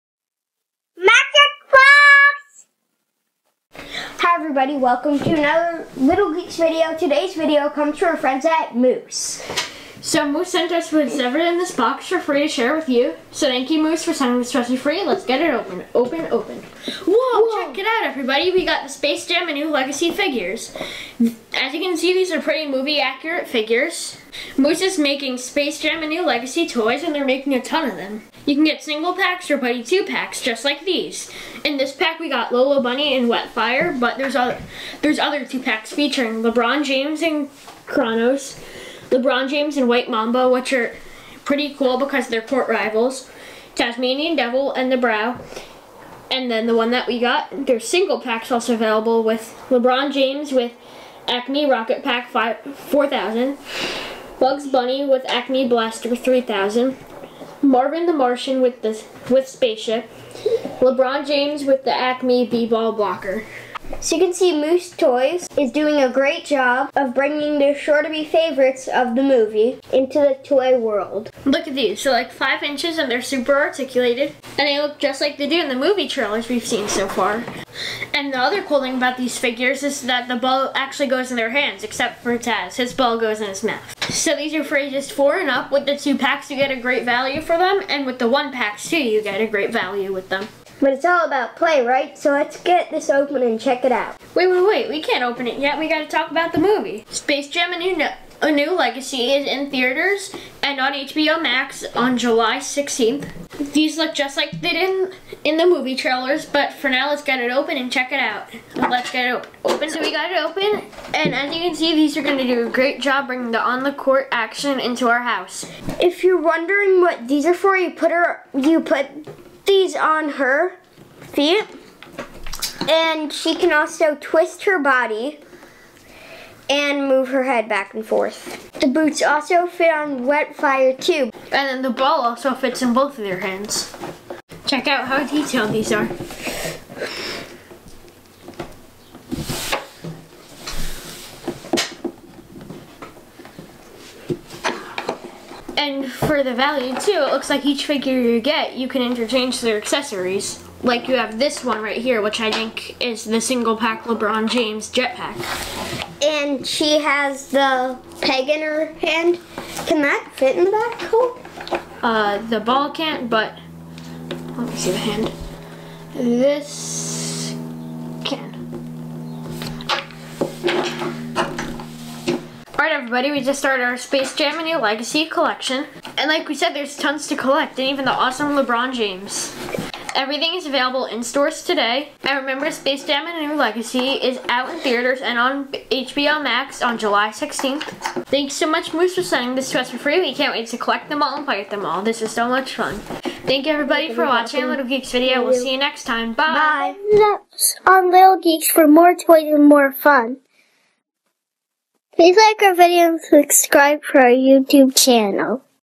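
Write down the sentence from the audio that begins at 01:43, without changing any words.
These look just like they did in, in the movie trailers, but for now, let's get it open and check it out.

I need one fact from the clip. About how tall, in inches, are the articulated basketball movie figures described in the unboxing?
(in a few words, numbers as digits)
5.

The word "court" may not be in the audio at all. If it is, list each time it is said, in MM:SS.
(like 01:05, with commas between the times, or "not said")
00:42, 01:53.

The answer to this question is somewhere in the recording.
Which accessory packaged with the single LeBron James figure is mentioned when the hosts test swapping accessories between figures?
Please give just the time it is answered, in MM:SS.
02:34.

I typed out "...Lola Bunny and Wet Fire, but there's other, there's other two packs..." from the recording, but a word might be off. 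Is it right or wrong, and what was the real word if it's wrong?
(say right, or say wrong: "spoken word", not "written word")
right.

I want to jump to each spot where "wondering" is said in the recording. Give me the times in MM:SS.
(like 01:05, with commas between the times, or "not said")
01:56.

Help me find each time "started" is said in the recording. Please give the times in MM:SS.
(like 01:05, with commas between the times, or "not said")
02:53.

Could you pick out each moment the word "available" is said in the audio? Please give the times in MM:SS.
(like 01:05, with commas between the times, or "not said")
00:48, 03:00.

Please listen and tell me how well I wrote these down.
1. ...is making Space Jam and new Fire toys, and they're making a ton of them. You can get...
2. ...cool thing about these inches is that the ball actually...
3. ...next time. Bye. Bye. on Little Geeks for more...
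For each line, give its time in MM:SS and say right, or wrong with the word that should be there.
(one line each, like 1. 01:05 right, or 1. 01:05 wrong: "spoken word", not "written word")
1. 00:24 wrong: "Legacy", not "Fire"
2. 01:18 wrong: "figures", not "inches"
3. 03:15 right.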